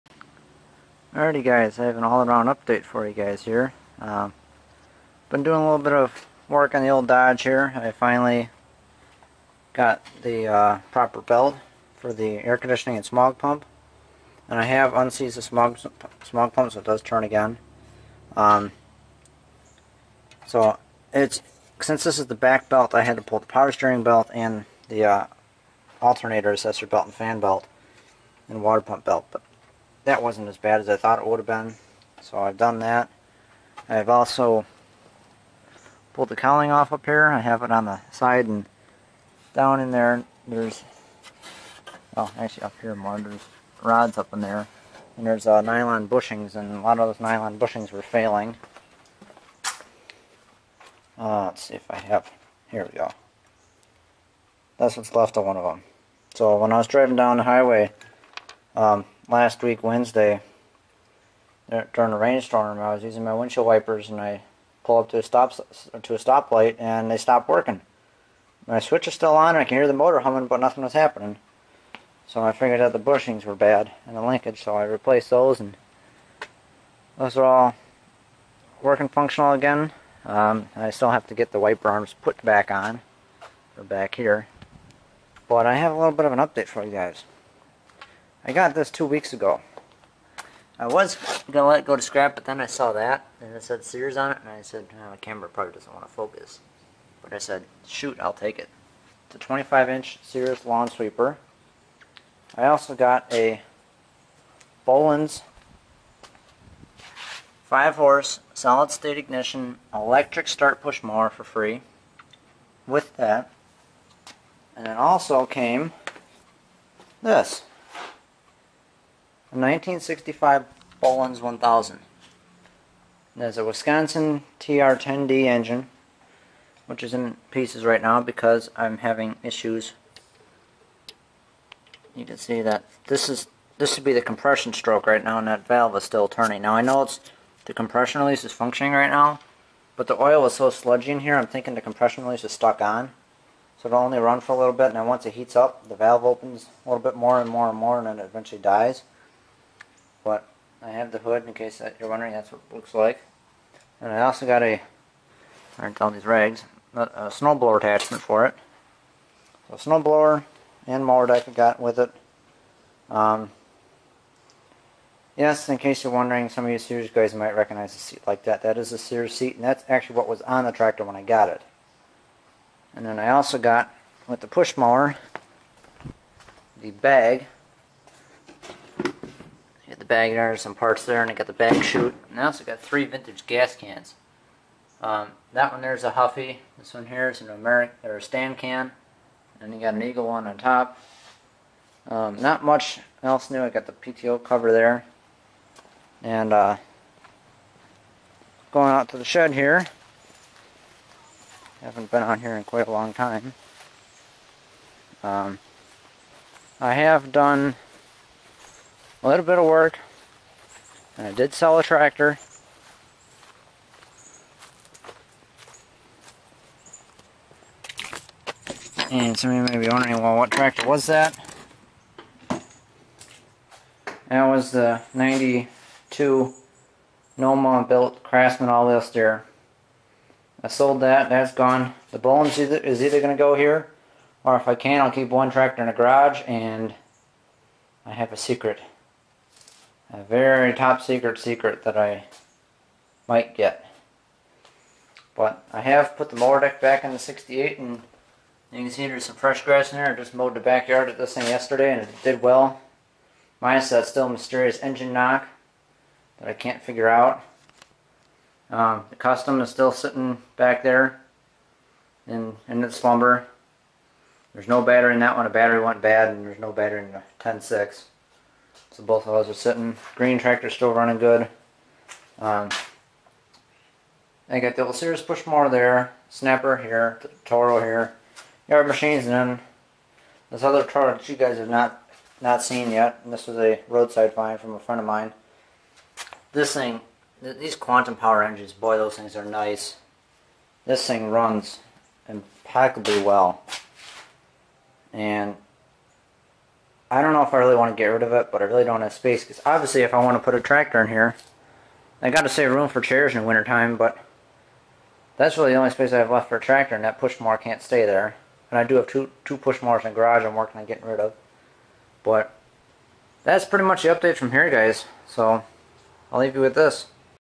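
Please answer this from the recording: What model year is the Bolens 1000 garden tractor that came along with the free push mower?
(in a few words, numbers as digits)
1965.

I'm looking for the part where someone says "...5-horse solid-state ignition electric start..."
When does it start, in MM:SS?
01:47.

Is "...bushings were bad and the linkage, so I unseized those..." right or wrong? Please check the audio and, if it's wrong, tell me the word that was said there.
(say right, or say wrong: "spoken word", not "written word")
wrong: "replaced", not "unseized".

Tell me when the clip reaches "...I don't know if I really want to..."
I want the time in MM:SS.
04:57.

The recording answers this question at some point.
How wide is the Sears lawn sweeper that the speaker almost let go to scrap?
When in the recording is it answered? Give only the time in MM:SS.
01:39.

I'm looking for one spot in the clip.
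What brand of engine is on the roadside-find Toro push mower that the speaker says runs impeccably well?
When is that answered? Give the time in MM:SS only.
04:47.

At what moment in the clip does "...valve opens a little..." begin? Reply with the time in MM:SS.
02:25.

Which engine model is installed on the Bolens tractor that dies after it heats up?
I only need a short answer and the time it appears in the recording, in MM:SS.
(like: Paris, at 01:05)
Wisconsin TR-10D, at 02:03.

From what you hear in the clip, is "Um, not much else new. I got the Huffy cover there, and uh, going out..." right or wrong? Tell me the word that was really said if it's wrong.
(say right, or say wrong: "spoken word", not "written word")
wrong: "PTO", not "Huffy".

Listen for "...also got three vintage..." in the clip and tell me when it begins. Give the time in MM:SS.
03:02.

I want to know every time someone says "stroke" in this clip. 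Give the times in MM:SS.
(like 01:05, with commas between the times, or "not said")
02:14.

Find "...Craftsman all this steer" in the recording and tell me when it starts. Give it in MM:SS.
03:48.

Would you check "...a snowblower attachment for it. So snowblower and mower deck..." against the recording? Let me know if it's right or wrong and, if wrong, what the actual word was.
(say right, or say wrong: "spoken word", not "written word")
right.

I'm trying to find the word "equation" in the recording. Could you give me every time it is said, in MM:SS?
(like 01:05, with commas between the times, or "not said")
not said.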